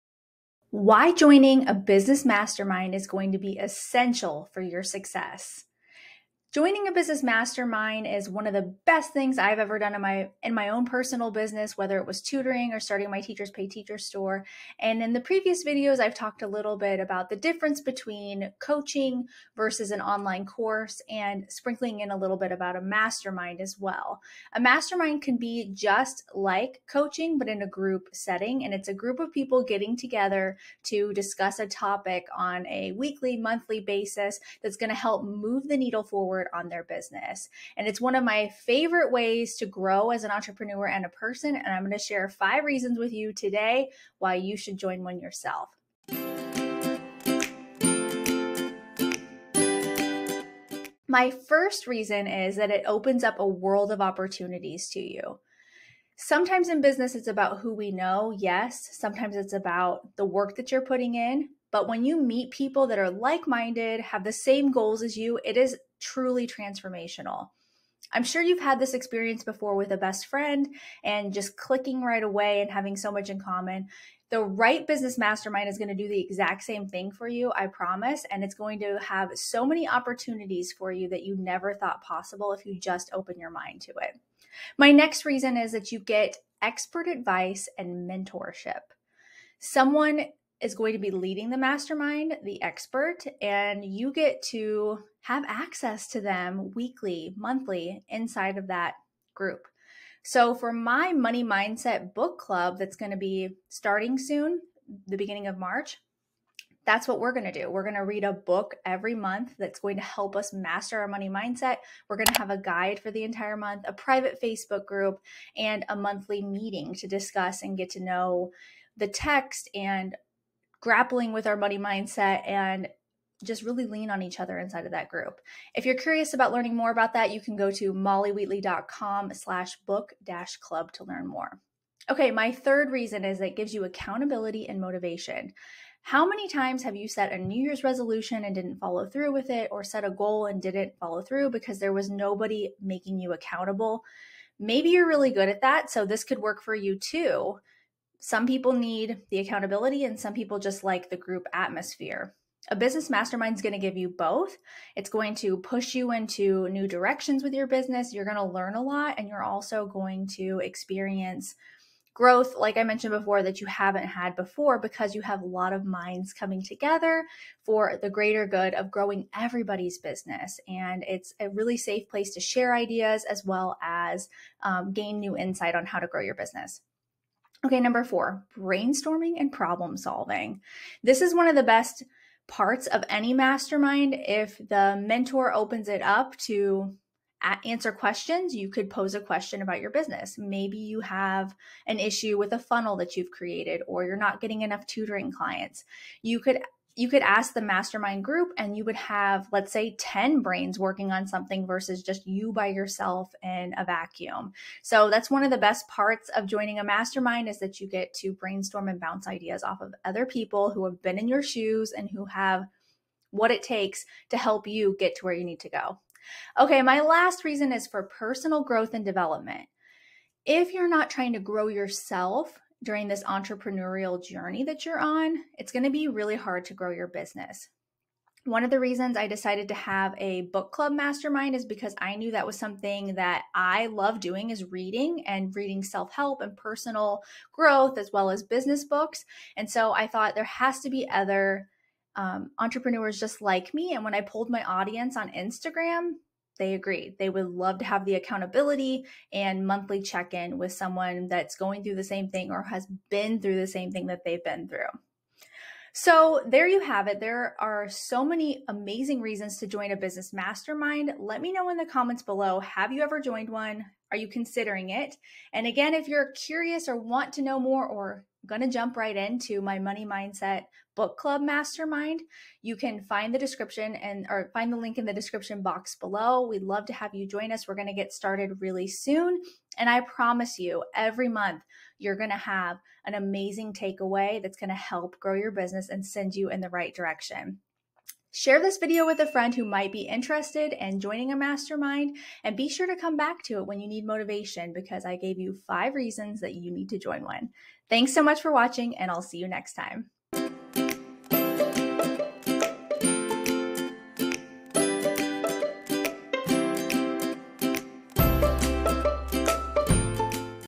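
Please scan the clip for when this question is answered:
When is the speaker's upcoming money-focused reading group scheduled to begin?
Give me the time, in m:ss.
1:45.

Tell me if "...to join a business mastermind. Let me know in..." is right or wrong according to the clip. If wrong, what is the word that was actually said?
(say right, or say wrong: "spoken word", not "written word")
right.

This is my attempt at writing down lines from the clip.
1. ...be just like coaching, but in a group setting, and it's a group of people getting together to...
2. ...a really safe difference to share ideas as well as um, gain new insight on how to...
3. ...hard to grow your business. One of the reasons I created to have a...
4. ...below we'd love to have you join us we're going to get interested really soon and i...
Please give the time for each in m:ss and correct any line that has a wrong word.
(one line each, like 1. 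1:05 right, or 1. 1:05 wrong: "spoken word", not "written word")
1. 0:25 right
2. 2:51 wrong: "place", not "difference"
3. 3:46 wrong: "decided", not "created"
4. 4:35 wrong: "started", not "interested".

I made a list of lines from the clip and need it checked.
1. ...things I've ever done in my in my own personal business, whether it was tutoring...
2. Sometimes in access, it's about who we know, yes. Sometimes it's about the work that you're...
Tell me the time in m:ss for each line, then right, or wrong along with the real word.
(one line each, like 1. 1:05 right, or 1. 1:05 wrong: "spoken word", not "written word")
1. 0:09 right
2. 0:56 wrong: "business", not "access".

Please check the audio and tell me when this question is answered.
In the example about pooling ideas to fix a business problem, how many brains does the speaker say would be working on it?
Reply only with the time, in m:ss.
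3:19.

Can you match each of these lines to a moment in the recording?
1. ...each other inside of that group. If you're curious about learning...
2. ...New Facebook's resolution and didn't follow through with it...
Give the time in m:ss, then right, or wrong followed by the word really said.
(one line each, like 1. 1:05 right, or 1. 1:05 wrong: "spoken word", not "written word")
1. 2:04 right
2. 2:17 wrong: "Year", not "Facebook".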